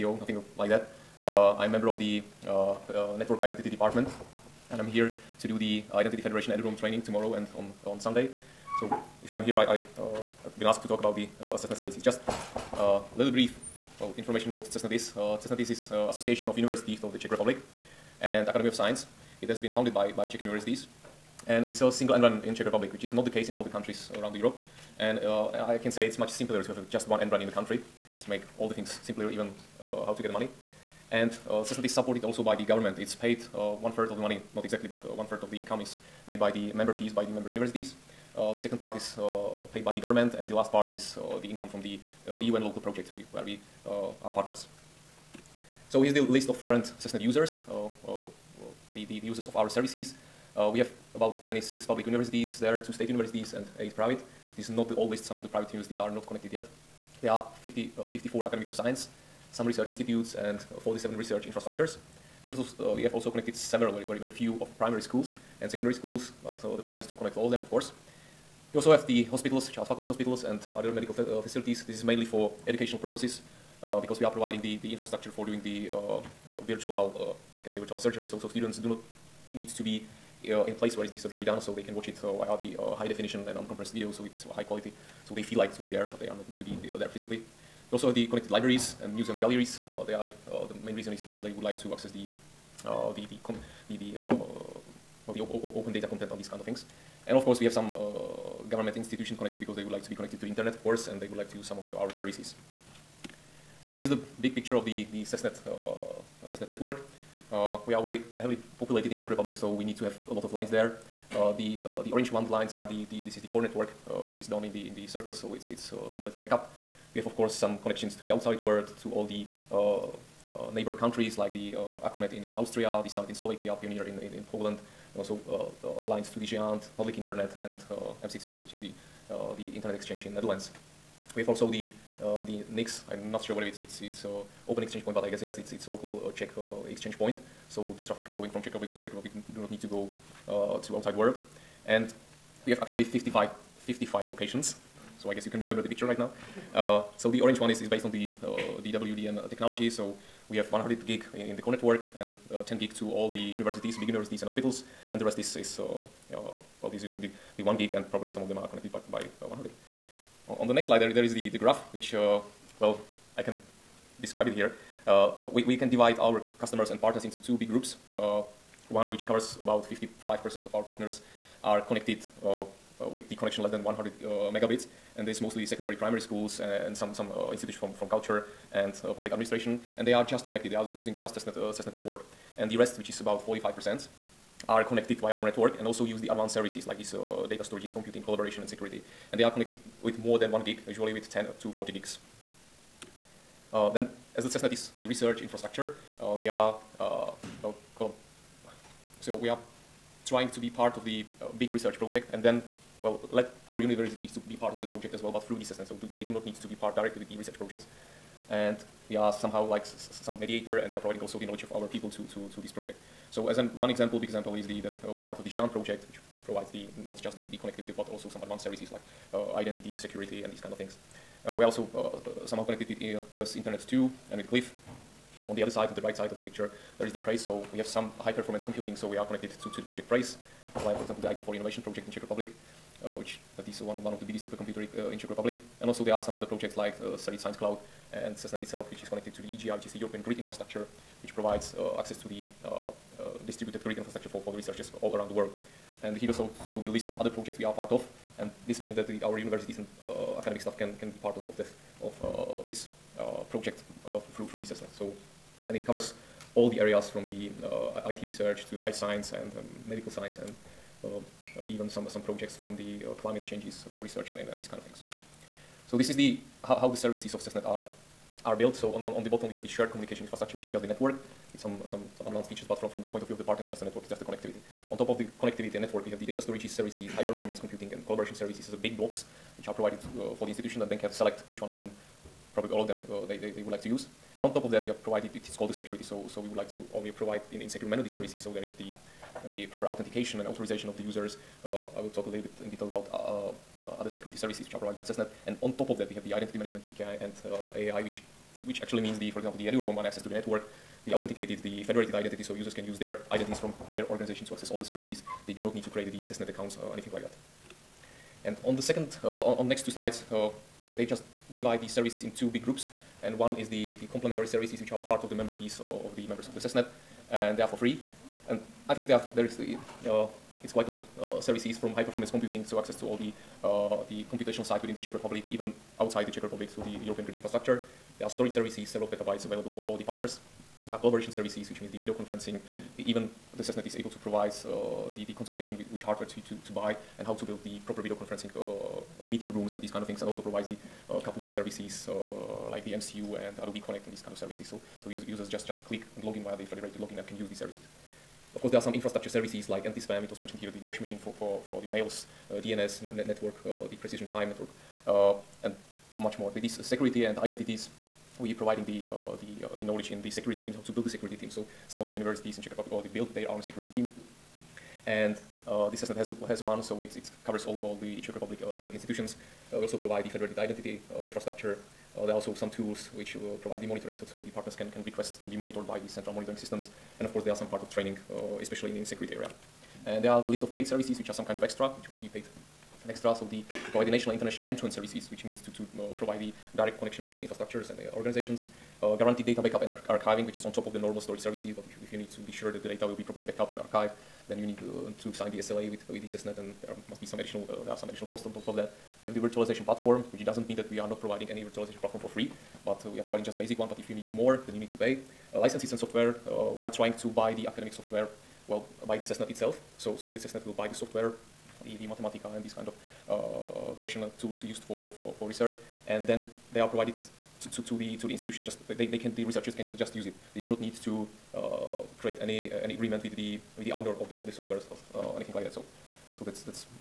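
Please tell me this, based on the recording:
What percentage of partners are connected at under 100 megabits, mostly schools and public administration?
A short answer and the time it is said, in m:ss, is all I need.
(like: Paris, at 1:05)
55%, at 2:49.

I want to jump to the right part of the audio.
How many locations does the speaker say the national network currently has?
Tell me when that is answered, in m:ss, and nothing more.
2:23.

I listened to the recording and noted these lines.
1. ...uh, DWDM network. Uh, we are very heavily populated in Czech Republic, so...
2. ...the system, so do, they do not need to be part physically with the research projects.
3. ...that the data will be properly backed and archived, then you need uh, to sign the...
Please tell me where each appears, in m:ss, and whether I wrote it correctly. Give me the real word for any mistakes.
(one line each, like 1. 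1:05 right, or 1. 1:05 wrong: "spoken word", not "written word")
1. 1:45 wrong: "CESNet", not "DWDM"
2. 3:25 wrong: "directly", not "physically"
3. 6:32 right.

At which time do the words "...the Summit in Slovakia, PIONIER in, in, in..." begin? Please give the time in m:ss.
2:03.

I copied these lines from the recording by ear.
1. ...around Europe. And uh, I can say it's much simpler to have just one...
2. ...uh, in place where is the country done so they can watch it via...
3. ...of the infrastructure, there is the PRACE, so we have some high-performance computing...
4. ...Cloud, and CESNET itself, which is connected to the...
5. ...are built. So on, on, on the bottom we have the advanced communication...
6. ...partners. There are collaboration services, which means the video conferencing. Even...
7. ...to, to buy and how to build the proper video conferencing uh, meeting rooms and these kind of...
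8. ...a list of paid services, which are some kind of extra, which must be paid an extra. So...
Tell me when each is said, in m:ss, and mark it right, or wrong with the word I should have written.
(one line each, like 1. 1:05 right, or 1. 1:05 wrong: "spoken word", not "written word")
1. 0:24 right
2. 1:20 wrong: "surgery", not "country"
3. 3:46 wrong: "picture", not "infrastructure"
4. 3:57 right
5. 4:28 wrong: "shared", not "advanced"
6. 5:30 right
7. 5:36 right
8. 6:20 right.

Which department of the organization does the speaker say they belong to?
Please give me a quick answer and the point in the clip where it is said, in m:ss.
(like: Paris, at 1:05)
Network Identity Department, at 0:03.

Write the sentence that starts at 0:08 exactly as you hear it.
So if I'm here, I, I uh, I've been asked to talk about the uh, assessment services.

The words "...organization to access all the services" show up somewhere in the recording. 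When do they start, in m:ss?
5:04.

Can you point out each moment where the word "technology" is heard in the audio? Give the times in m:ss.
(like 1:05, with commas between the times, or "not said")
2:29.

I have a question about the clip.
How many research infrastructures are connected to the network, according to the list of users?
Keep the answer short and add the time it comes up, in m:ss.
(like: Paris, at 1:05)
47, at 1:00.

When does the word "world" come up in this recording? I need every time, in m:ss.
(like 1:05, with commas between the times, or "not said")
1:58, 2:21, 4:05.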